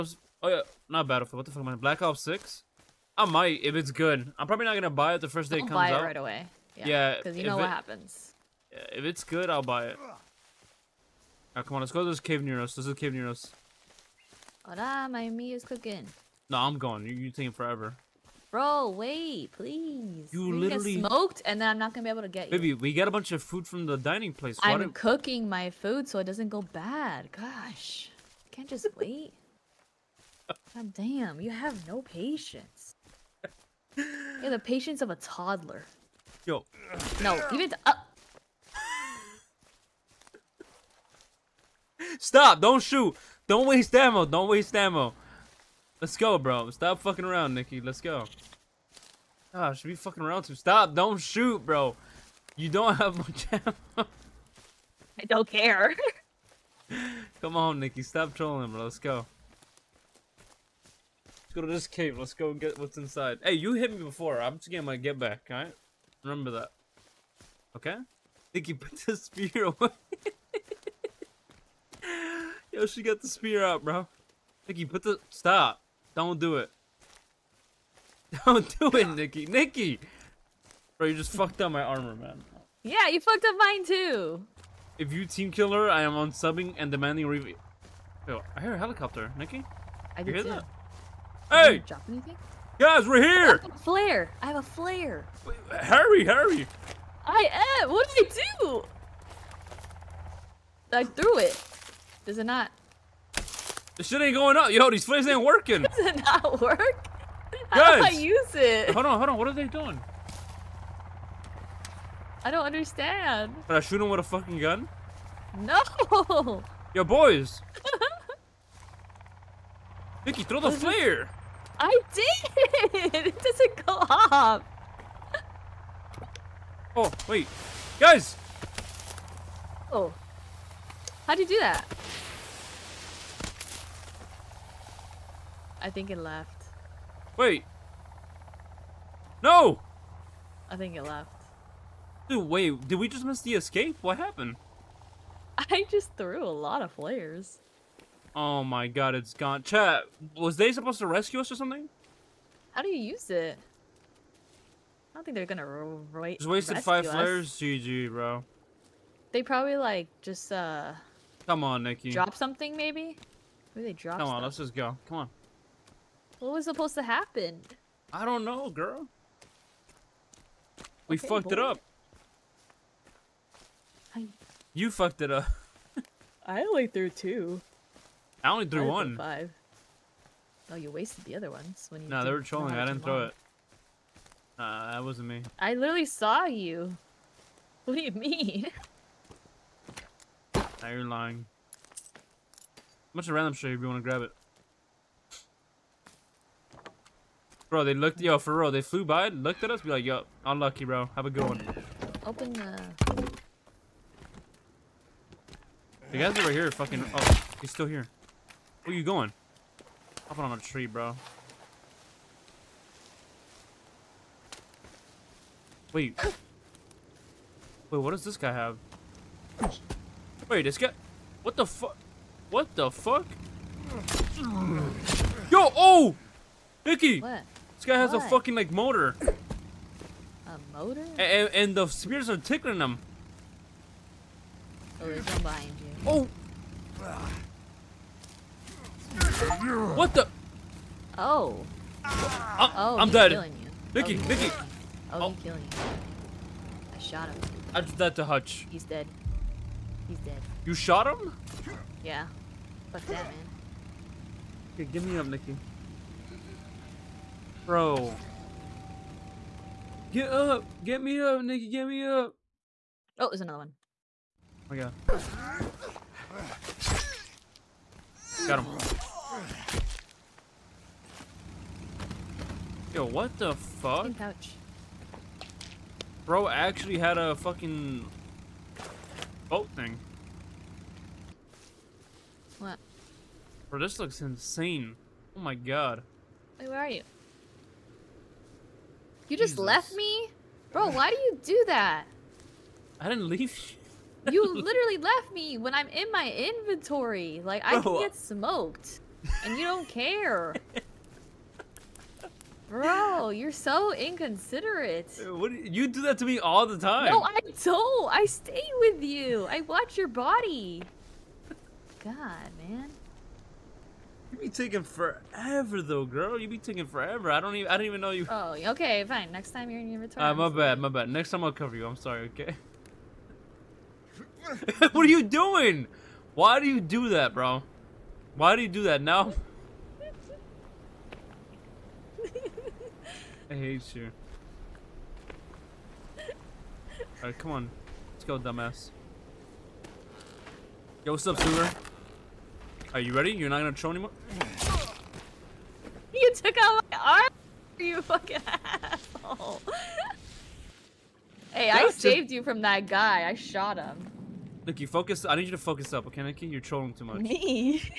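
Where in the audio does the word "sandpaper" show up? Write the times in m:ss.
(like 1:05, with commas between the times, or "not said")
not said.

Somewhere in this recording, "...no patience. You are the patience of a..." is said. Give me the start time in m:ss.
0:31.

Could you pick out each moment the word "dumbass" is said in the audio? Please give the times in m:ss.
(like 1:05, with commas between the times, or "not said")
5:38.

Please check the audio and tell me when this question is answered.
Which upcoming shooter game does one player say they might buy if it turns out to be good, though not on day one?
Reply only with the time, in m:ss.
0:01.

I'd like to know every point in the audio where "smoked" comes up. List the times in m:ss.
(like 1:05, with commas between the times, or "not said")
0:21, 4:58.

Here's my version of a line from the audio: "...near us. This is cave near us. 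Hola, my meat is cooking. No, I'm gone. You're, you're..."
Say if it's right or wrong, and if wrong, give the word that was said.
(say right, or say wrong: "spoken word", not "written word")
right.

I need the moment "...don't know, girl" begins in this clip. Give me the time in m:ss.
2:48.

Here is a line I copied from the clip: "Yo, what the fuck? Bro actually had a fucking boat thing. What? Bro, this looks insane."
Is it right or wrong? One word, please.
right.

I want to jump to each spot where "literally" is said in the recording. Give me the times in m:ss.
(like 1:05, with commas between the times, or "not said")
0:20, 3:05, 4:54.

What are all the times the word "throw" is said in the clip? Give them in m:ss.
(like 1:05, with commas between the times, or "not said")
2:00, 3:03, 5:43.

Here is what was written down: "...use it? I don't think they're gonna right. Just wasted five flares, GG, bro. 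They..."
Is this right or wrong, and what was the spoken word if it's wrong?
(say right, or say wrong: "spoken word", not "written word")
right.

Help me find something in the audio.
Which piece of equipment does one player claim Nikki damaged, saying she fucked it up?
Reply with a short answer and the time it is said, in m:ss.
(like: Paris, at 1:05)
Armor, at 1:21.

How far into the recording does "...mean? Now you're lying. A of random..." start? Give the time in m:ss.
3:08.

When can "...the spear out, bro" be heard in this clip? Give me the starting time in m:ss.
1:13.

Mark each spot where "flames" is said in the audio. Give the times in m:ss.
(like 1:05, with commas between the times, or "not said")
1:45.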